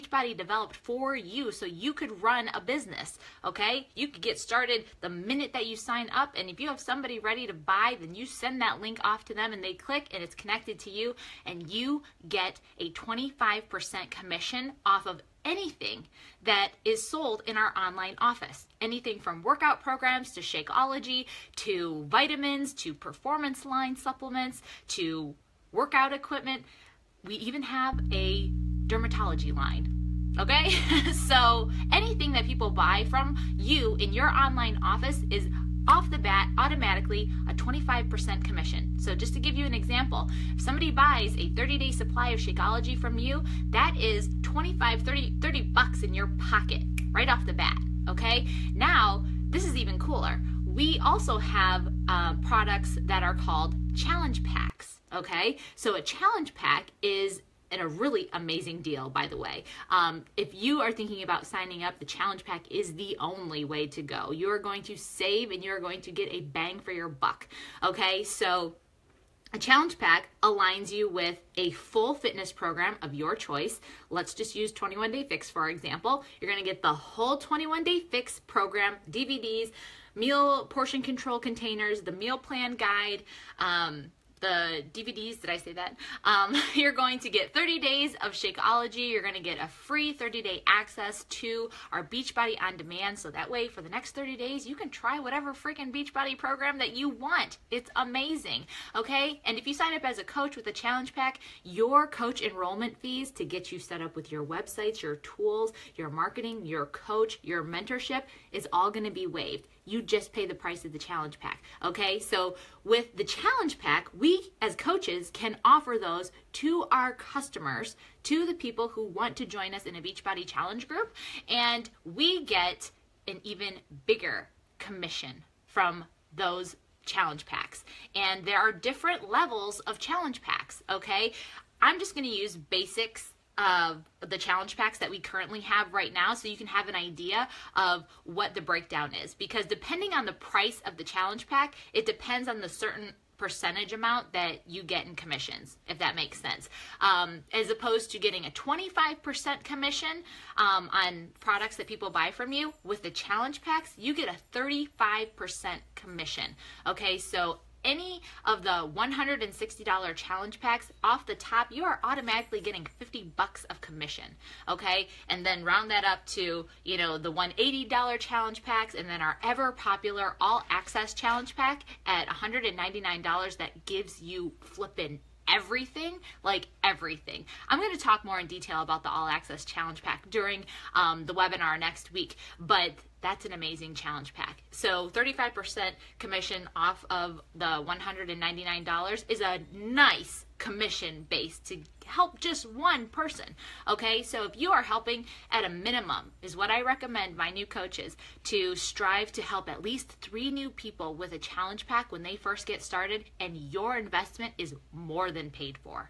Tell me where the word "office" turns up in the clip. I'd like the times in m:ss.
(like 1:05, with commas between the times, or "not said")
0:18, 0:34.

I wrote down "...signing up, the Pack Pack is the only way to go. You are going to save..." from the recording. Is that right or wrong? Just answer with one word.
wrong.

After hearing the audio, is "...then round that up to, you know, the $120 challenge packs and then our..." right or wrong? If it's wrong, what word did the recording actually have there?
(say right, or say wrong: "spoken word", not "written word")
wrong: "180", not "120".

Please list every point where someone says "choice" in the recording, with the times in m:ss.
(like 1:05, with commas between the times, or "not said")
1:13.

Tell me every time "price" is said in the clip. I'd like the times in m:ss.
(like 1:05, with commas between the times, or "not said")
1:50, 2:20.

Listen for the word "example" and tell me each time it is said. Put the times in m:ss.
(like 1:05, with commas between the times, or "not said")
0:39, 1:15.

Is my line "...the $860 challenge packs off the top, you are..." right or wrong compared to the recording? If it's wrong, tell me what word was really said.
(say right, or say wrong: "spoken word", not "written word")
wrong: "160", not "860".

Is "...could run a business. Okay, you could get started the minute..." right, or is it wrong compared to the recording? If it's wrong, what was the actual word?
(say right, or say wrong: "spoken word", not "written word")
right.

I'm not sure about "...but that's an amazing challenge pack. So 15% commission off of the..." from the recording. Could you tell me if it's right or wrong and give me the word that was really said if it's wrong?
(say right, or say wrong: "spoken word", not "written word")
wrong: "35", not "15".